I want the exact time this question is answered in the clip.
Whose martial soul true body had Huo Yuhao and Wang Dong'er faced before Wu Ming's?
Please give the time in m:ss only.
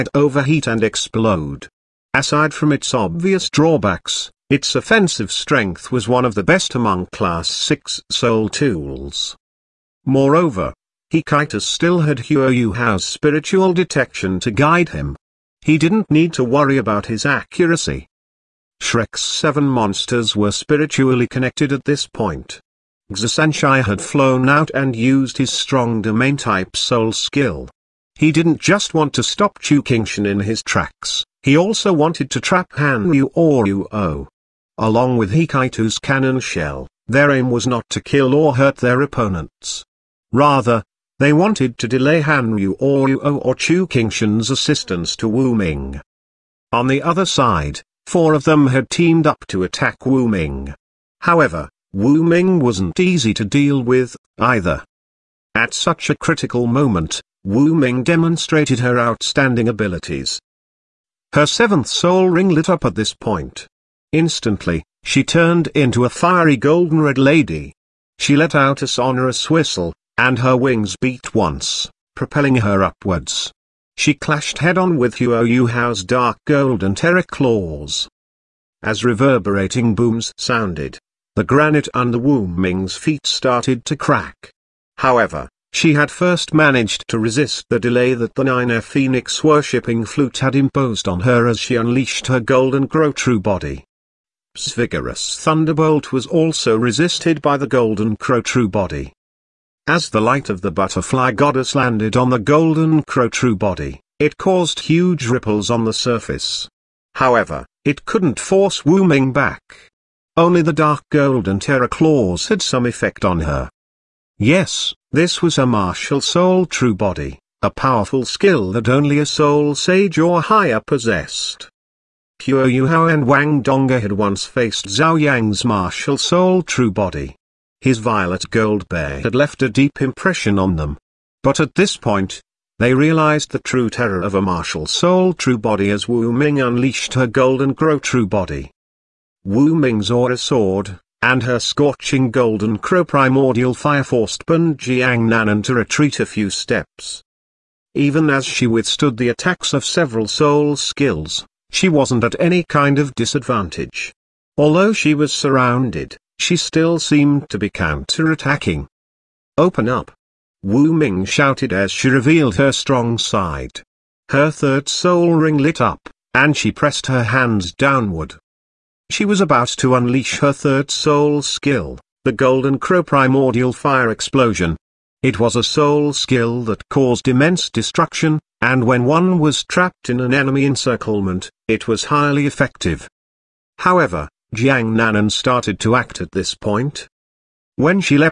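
2:04.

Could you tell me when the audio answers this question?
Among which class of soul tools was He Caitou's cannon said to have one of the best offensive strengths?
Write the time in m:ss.
0:07.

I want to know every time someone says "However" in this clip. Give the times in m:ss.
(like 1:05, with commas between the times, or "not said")
0:51, 1:24, 1:47, 3:03.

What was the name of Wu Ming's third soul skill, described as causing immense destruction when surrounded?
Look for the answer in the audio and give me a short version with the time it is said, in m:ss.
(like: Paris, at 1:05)
Golden Crow Primordial Fire Explosion, at 2:52.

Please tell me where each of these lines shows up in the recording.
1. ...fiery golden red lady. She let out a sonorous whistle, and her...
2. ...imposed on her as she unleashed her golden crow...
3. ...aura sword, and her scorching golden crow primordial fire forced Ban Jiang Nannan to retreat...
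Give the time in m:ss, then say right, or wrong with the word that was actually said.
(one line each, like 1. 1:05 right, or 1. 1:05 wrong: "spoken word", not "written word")
1. 1:06 right
2. 1:30 right
3. 2:20 right.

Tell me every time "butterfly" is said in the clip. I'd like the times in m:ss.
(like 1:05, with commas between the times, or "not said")
1:40.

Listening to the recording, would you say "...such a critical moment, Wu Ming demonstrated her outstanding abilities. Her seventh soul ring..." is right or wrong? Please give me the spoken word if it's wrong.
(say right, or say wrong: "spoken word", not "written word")
right.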